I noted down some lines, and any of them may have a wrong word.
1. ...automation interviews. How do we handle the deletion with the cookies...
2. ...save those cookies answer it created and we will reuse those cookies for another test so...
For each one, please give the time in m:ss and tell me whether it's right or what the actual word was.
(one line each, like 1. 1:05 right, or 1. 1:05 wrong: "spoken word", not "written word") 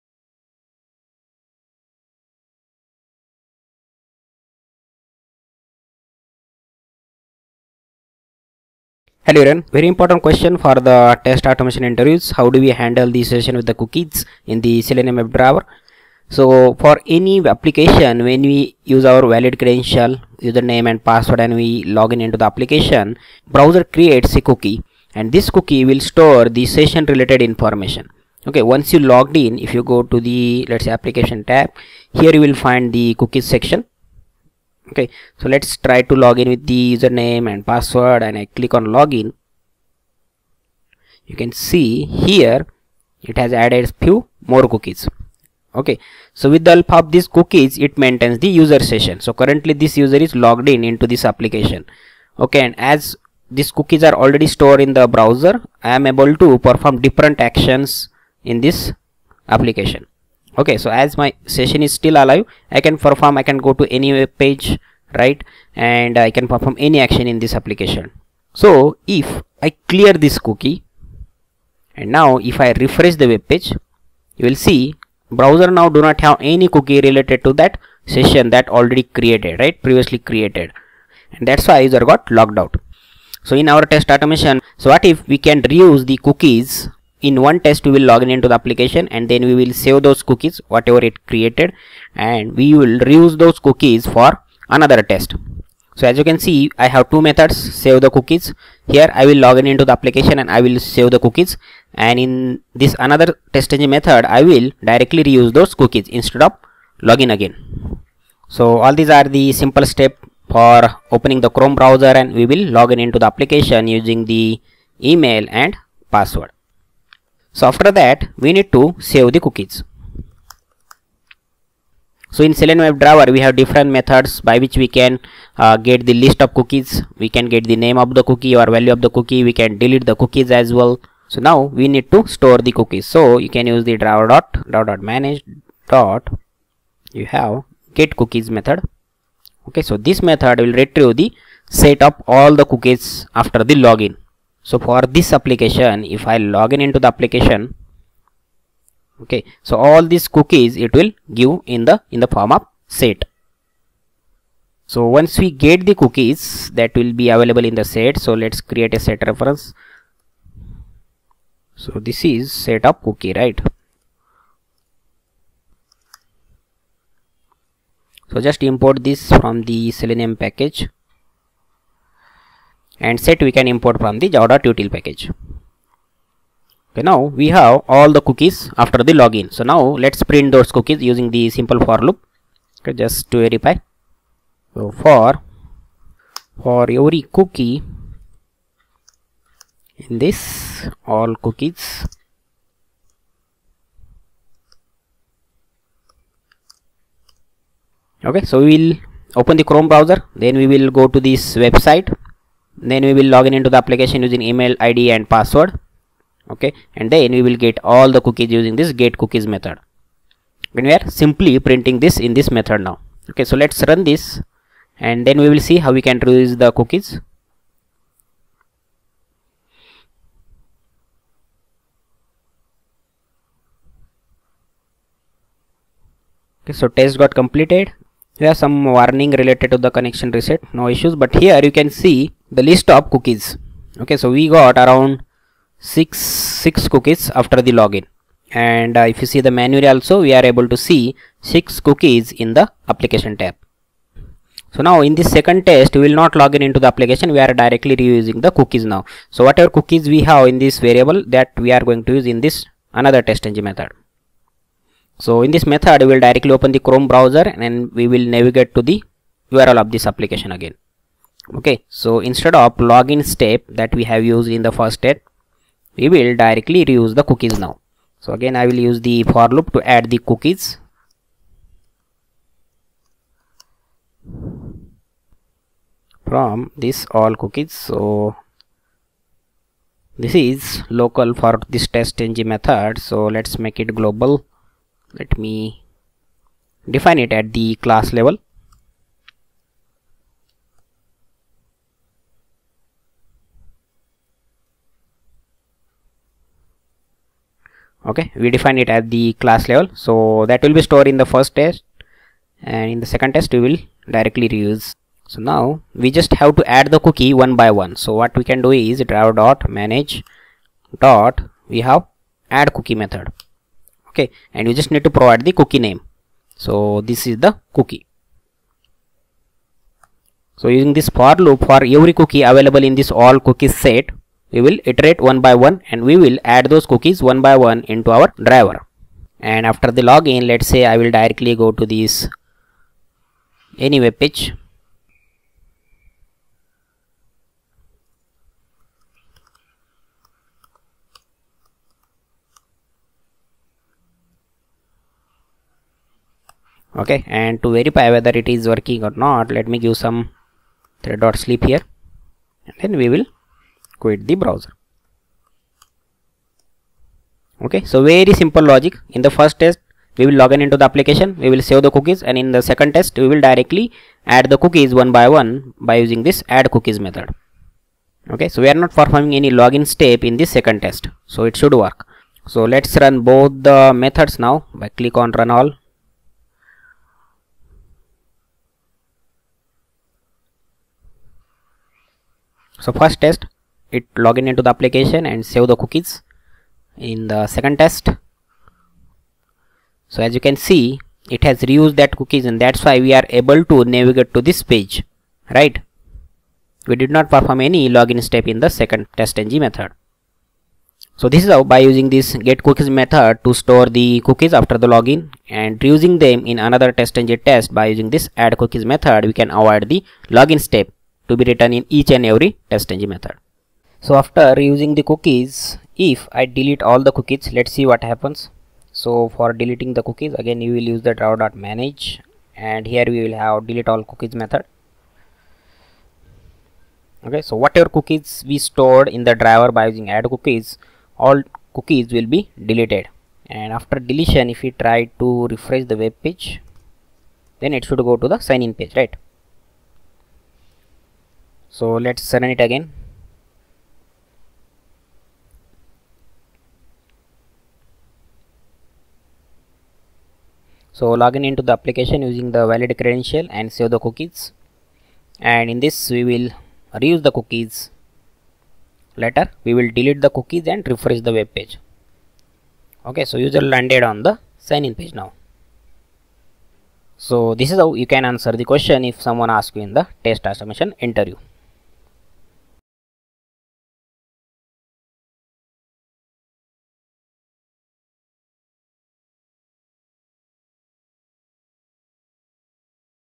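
1. 0:11 wrong: "session", not "deletion"
2. 1:29 wrong: "whatever", not "answer".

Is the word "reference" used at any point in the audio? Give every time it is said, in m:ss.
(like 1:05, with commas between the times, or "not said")
2:39.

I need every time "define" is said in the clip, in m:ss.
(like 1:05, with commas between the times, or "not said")
4:46, 4:58.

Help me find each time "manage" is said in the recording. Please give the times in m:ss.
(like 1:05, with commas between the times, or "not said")
2:15, 5:09, 7:01.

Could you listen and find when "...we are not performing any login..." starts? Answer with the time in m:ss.
6:08.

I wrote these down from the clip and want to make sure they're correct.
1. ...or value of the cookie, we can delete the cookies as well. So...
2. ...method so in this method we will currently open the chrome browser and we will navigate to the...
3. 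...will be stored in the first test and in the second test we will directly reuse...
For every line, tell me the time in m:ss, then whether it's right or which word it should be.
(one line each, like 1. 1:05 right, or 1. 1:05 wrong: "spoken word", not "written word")
1. 2:08 right
2. 4:13 wrong: "directly", not "currently"
3. 5:00 right.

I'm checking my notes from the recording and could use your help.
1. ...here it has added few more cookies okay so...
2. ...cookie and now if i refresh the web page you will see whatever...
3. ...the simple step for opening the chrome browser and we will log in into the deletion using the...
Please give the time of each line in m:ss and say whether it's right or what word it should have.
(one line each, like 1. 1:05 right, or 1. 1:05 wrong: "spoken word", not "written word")
1. 0:42 right
2. 1:10 wrong: "browser", not "whatever"
3. 1:49 wrong: "application", not "deletion".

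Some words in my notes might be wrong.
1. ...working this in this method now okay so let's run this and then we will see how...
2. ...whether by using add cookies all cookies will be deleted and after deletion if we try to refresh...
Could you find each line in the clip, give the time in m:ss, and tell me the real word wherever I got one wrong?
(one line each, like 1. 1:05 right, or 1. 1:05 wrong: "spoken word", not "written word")
1. 3:31 wrong: "printing", not "working"
2. 7:09 wrong: "driver", not "whether".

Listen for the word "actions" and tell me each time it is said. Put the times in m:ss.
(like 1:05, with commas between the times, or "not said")
0:57, 1:06.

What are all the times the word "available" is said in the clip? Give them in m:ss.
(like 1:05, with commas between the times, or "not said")
2:37, 5:22.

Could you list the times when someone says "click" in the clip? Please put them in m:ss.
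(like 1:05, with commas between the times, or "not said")
0:38, 6:14.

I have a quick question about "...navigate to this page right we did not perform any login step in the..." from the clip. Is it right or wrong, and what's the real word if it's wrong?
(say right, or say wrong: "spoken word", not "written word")
right.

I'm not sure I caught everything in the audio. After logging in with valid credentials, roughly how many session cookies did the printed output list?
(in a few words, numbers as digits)
6.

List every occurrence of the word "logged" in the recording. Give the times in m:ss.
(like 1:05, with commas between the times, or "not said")
0:28, 0:50, 1:22.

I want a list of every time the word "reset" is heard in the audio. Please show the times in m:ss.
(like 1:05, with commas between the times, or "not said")
3:50.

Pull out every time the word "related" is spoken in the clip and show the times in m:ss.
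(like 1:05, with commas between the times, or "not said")
0:27, 1:17, 3:49.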